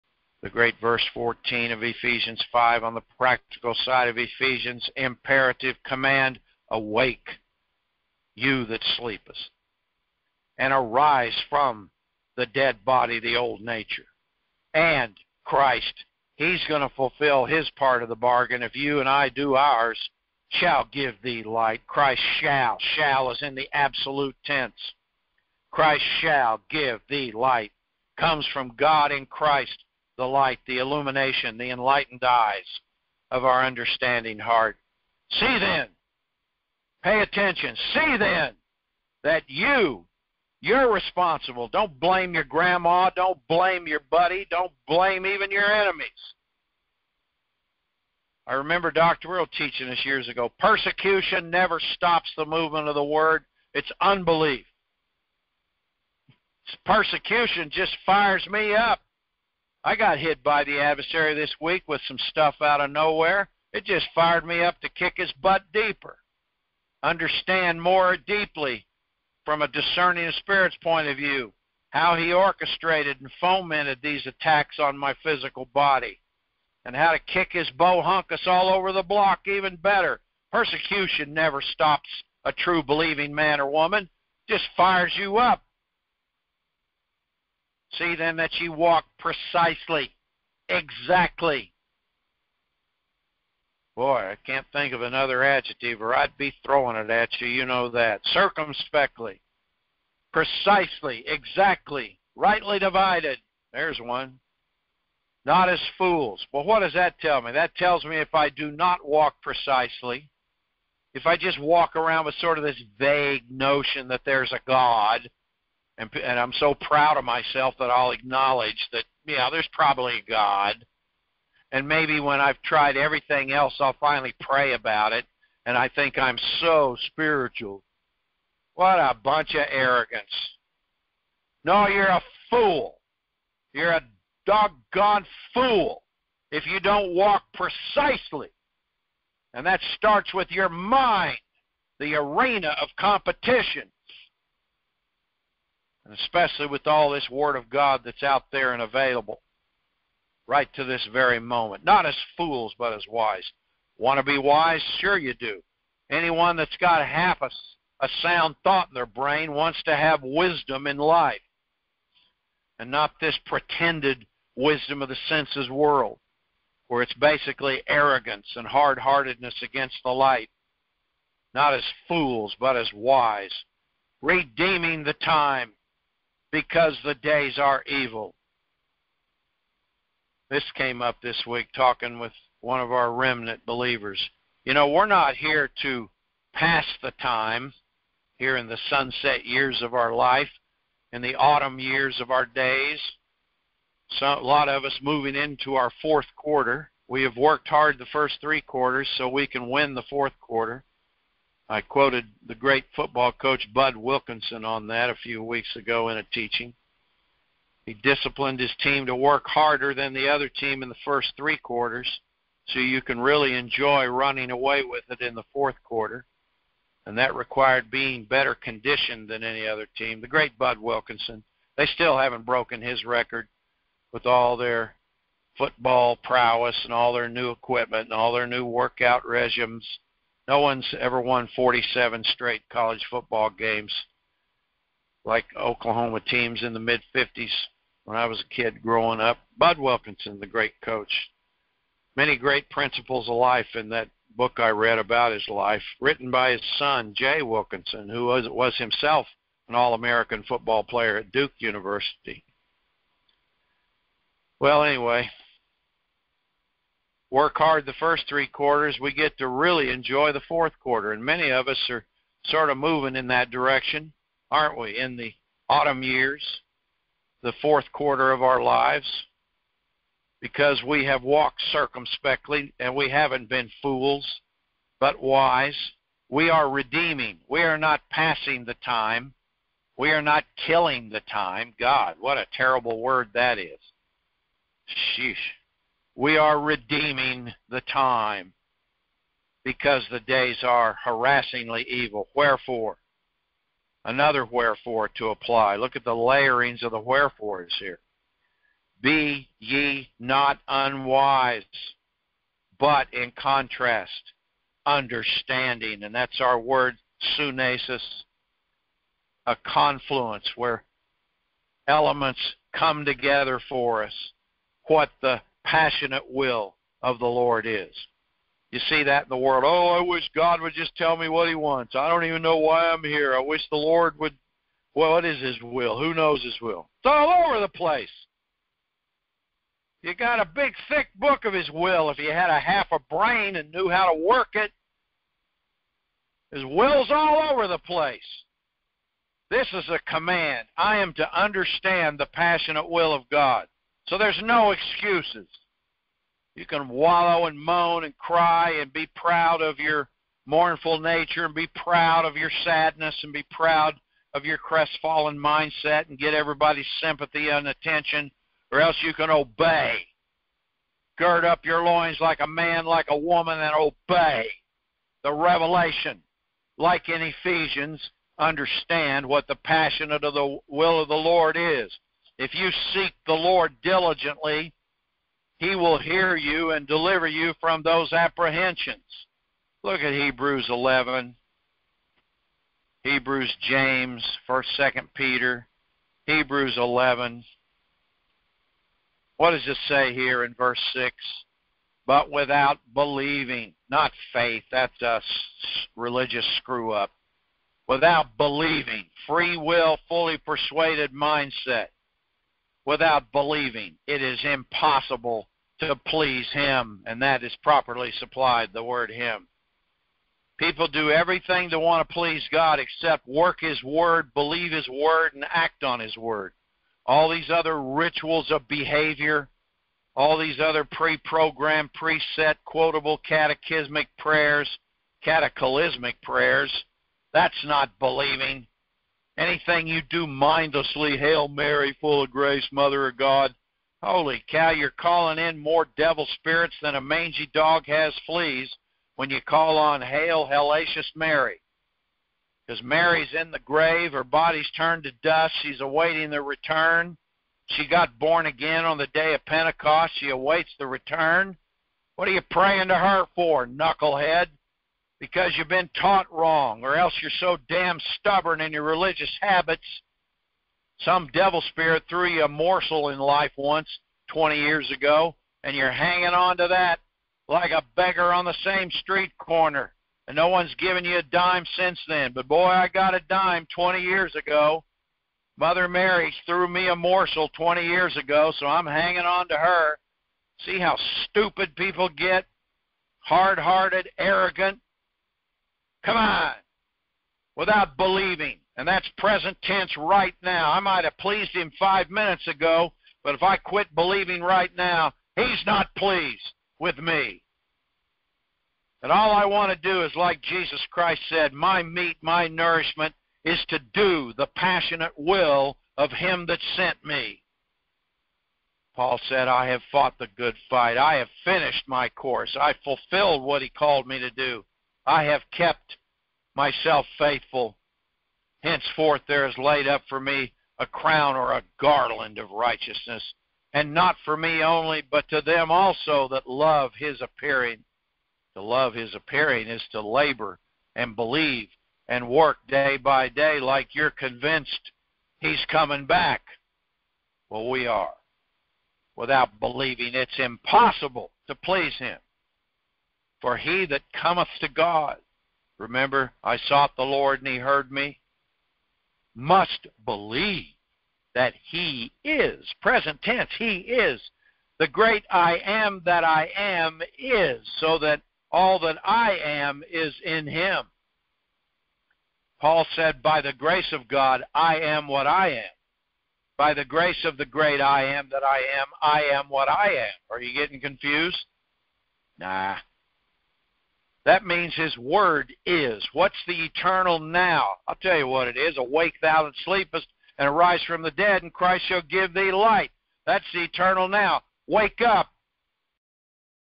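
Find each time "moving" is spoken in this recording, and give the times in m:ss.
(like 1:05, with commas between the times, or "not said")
3:15, 4:22.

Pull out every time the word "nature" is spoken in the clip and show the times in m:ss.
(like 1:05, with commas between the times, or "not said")
0:13, 5:50.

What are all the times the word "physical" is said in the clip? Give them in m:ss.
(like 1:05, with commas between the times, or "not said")
1:15.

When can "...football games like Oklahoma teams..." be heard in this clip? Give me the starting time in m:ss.
3:53.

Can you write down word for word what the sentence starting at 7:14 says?
Holy cow, you're calling in more devil spirits than a mangy dog has fleas when you call on Hail, Hellacious Mary.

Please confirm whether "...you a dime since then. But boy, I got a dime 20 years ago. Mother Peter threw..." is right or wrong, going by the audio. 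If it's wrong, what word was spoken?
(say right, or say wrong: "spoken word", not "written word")
wrong: "Mary", not "Peter".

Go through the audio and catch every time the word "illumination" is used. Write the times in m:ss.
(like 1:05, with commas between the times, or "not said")
0:30.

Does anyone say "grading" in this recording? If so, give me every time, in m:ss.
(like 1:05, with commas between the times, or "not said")
not said.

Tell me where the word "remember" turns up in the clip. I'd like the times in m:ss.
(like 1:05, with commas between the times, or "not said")
0:48, 9:05.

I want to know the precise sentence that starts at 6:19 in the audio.
Look at Hebrews 11, Hebrews, James, 1st, 2nd Peter, Hebrews 11.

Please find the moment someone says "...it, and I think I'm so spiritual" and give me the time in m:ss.
2:05.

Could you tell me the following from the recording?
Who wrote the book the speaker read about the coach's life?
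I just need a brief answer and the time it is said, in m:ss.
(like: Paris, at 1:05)
Jay Wilkinson, at 4:07.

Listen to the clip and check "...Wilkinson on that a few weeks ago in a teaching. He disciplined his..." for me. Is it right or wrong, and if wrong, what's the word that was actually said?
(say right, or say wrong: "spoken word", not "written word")
right.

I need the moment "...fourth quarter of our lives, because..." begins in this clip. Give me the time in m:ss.
4:27.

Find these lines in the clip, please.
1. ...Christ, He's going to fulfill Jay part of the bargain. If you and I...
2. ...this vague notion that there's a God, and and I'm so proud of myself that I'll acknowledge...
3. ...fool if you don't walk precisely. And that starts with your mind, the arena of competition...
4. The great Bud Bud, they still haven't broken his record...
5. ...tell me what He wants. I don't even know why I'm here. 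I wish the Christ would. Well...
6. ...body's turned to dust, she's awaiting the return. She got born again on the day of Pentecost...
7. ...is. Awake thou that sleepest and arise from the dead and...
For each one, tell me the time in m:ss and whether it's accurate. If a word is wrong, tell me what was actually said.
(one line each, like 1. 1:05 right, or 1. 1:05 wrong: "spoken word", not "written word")
1. 0:15 wrong: "His", not "Jay"
2. 1:52 right
3. 2:15 right
4. 3:40 wrong: "Wilkinson", not "Bud"
5. 5:20 wrong: "Lord", not "Christ"
6. 7:24 right
7. 9:38 right.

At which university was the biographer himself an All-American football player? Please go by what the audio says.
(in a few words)
Duke University.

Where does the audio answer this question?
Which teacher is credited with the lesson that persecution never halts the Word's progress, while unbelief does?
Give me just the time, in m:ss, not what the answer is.
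0:48.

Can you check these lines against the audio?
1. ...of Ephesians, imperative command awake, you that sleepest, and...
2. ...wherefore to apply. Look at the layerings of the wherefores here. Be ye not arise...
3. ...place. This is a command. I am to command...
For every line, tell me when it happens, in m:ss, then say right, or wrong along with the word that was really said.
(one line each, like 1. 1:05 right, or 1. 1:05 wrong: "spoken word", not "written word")
1. 0:04 right
2. 4:54 wrong: "unwise", not "arise"
3. 5:37 wrong: "understand", not "command".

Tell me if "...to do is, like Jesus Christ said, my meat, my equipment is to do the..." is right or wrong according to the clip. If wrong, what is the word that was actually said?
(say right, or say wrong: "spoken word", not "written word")
wrong: "nourishment", not "equipment".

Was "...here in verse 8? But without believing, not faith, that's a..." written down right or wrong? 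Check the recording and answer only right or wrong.
wrong.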